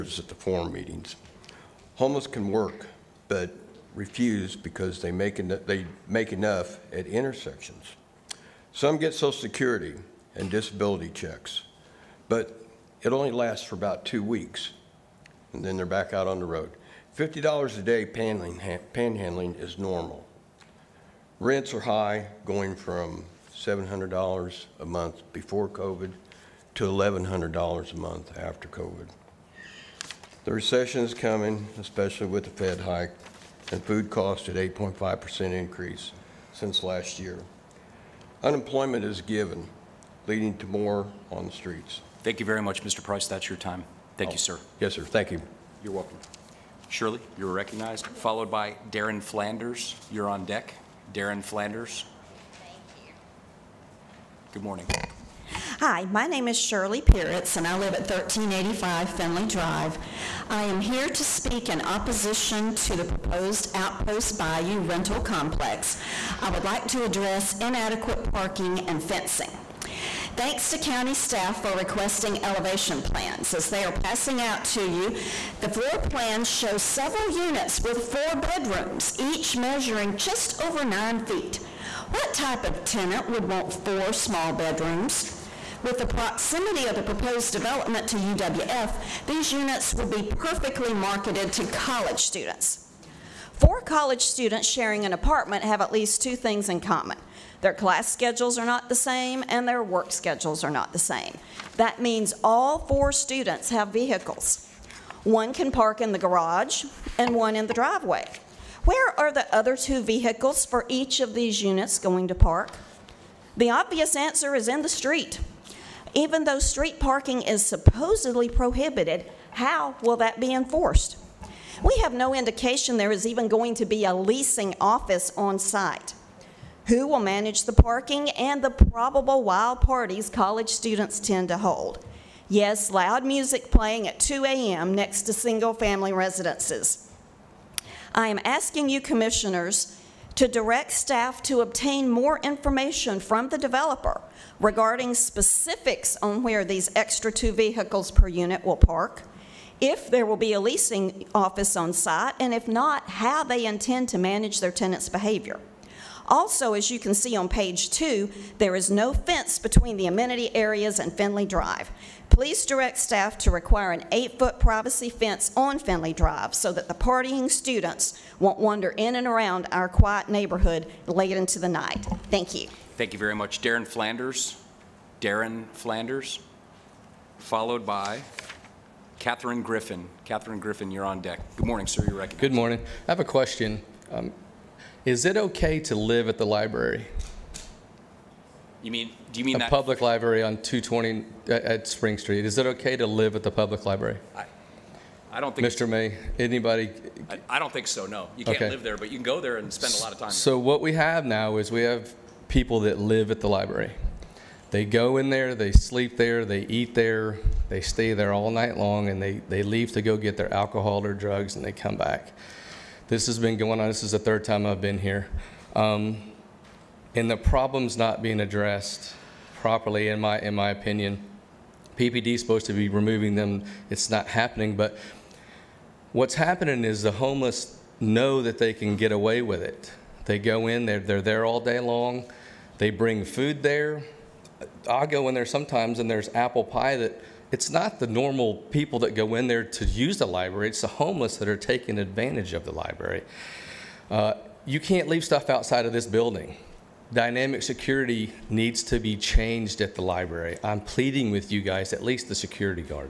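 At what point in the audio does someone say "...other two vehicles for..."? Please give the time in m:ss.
1:49.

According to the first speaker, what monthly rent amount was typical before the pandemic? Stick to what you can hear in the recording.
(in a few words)
$700.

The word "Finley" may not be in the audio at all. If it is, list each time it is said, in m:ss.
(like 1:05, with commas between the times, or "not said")
0:59, 2:41, 2:45.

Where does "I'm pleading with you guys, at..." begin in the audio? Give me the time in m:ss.
4:10.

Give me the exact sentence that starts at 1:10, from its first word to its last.
Thanks to county staff for requesting elevation plans.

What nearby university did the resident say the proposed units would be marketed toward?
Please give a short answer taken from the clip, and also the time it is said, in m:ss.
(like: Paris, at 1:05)
UWF, at 1:28.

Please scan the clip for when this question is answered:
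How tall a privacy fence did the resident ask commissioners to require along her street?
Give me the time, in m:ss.
2:44.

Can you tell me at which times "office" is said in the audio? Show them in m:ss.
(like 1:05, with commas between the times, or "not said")
2:04, 2:31.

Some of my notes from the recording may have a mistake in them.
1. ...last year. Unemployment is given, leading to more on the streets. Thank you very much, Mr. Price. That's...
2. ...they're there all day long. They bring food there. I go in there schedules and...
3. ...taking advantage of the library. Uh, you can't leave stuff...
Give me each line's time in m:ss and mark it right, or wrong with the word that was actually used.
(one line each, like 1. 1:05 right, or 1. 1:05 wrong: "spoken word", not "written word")
1. 0:36 right
2. 3:50 wrong: "sometimes", not "schedules"
3. 4:01 right.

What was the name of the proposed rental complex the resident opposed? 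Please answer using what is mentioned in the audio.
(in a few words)
Outpost Bayou.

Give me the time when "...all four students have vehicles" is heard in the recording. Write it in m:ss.
1:42.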